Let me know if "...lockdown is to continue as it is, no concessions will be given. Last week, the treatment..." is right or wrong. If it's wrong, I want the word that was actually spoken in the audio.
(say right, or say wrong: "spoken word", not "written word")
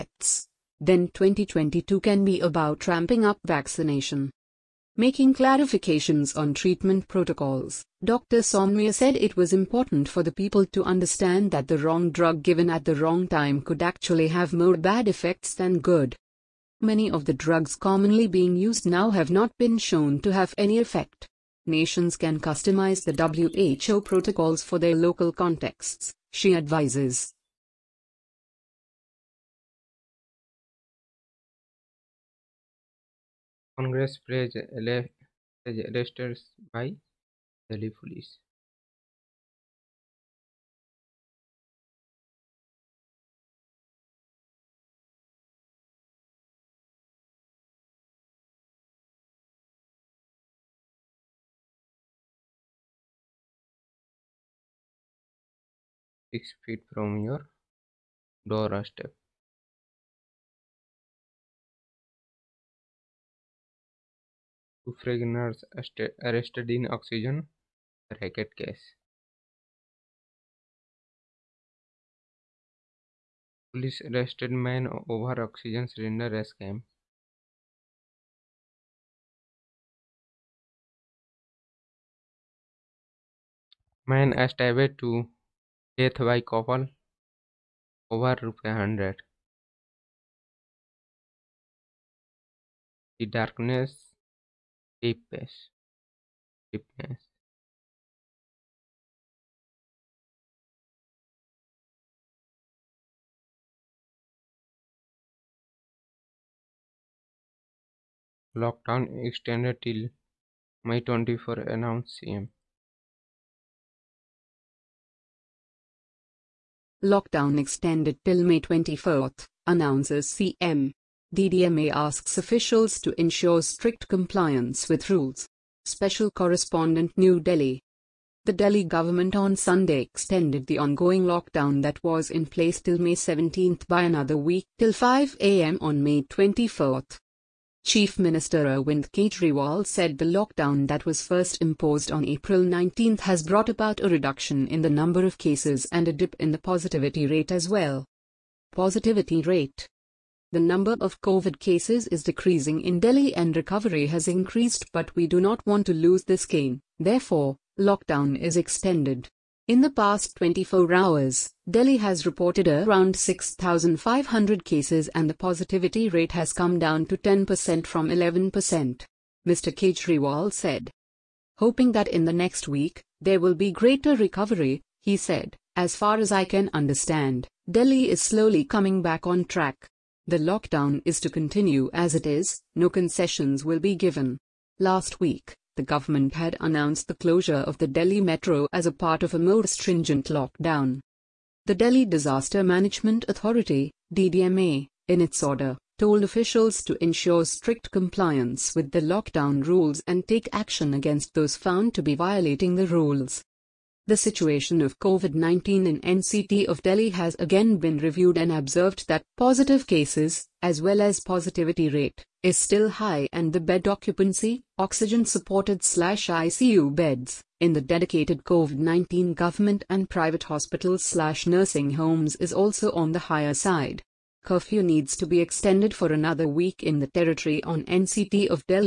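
wrong: "government", not "treatment".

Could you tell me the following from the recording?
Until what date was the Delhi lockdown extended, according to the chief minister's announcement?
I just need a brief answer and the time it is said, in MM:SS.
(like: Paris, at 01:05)
May 24, at 01:58.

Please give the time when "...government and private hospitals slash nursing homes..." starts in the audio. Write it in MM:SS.
03:39.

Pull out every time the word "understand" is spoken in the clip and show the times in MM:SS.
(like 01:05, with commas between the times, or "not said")
00:10, 02:56.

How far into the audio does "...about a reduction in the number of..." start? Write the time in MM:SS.
02:23.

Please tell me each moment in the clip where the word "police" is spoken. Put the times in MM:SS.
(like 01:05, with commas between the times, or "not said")
00:37, 01:13.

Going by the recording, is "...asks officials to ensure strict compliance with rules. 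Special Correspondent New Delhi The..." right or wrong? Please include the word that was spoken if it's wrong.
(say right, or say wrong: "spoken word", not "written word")
right.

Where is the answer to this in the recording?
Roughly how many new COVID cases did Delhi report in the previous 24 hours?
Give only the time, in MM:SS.
02:43.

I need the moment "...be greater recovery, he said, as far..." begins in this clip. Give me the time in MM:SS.
02:53.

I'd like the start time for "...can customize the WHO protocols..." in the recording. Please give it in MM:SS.
00:22.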